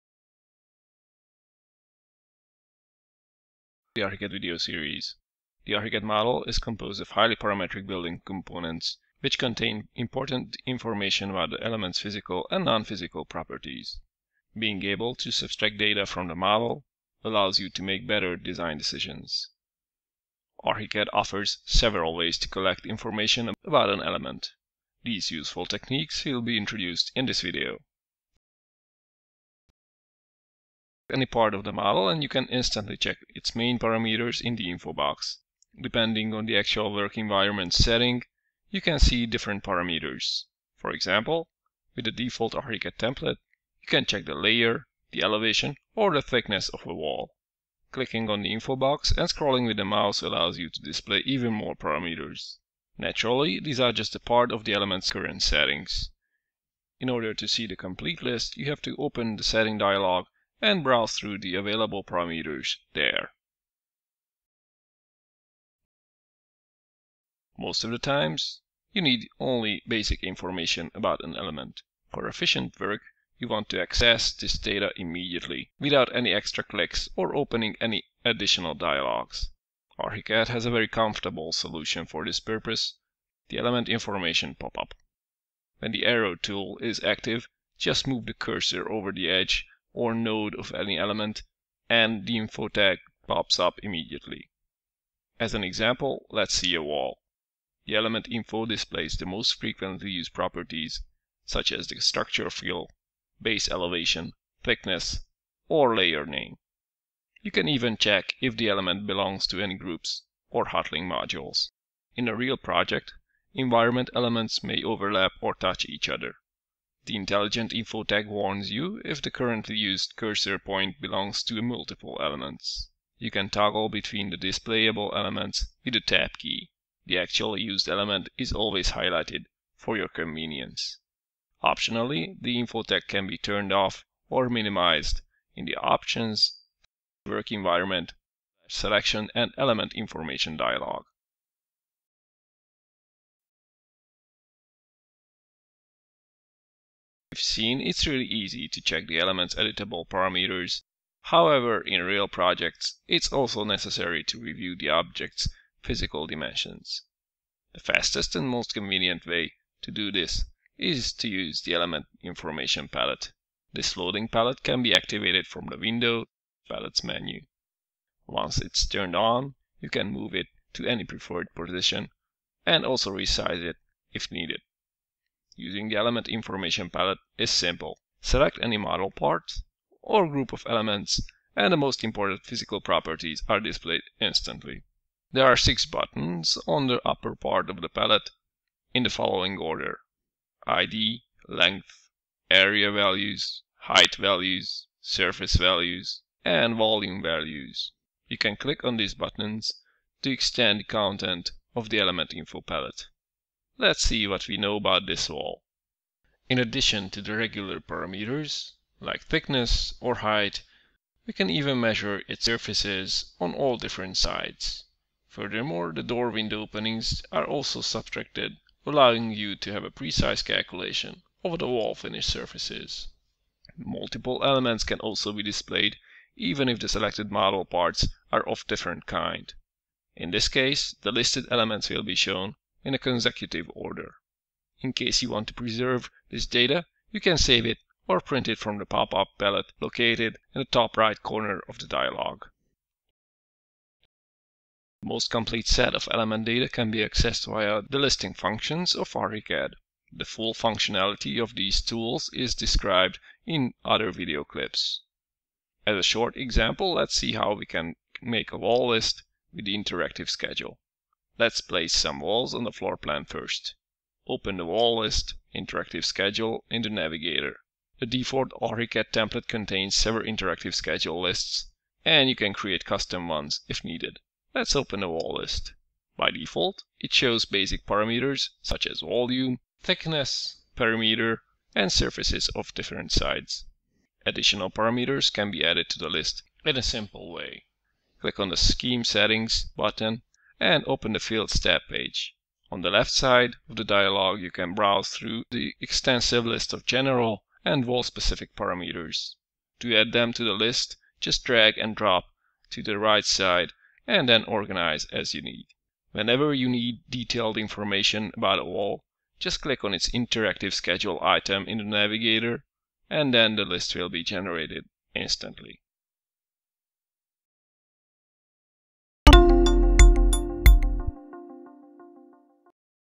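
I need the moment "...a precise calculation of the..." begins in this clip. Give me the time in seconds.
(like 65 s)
219 s.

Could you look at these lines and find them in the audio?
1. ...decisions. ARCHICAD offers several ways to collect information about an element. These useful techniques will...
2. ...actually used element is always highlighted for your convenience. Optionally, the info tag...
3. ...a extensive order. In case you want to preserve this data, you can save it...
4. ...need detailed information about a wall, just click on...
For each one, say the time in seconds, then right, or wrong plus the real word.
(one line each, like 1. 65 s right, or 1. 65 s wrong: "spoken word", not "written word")
1. 18 s right
2. 127 s right
3. 232 s wrong: "consecutive", not "extensive"
4. 306 s right.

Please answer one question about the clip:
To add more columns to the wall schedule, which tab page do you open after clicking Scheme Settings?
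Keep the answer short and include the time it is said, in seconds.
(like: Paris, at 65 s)
Fields, at 291 s.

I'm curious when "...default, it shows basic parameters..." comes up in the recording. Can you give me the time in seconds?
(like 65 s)
276 s.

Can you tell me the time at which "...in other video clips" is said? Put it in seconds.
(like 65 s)
253 s.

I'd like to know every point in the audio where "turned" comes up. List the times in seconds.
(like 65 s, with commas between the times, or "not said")
133 s, 168 s.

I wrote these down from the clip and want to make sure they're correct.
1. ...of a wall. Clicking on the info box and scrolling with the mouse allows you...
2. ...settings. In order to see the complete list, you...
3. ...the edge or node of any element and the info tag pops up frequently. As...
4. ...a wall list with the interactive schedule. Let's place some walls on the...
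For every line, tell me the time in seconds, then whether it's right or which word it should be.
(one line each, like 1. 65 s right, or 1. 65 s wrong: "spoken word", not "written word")
1. 46 s right
2. 55 s right
3. 89 s wrong: "immediately", not "frequently"
4. 258 s right.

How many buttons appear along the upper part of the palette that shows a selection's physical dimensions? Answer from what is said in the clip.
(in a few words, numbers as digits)
6.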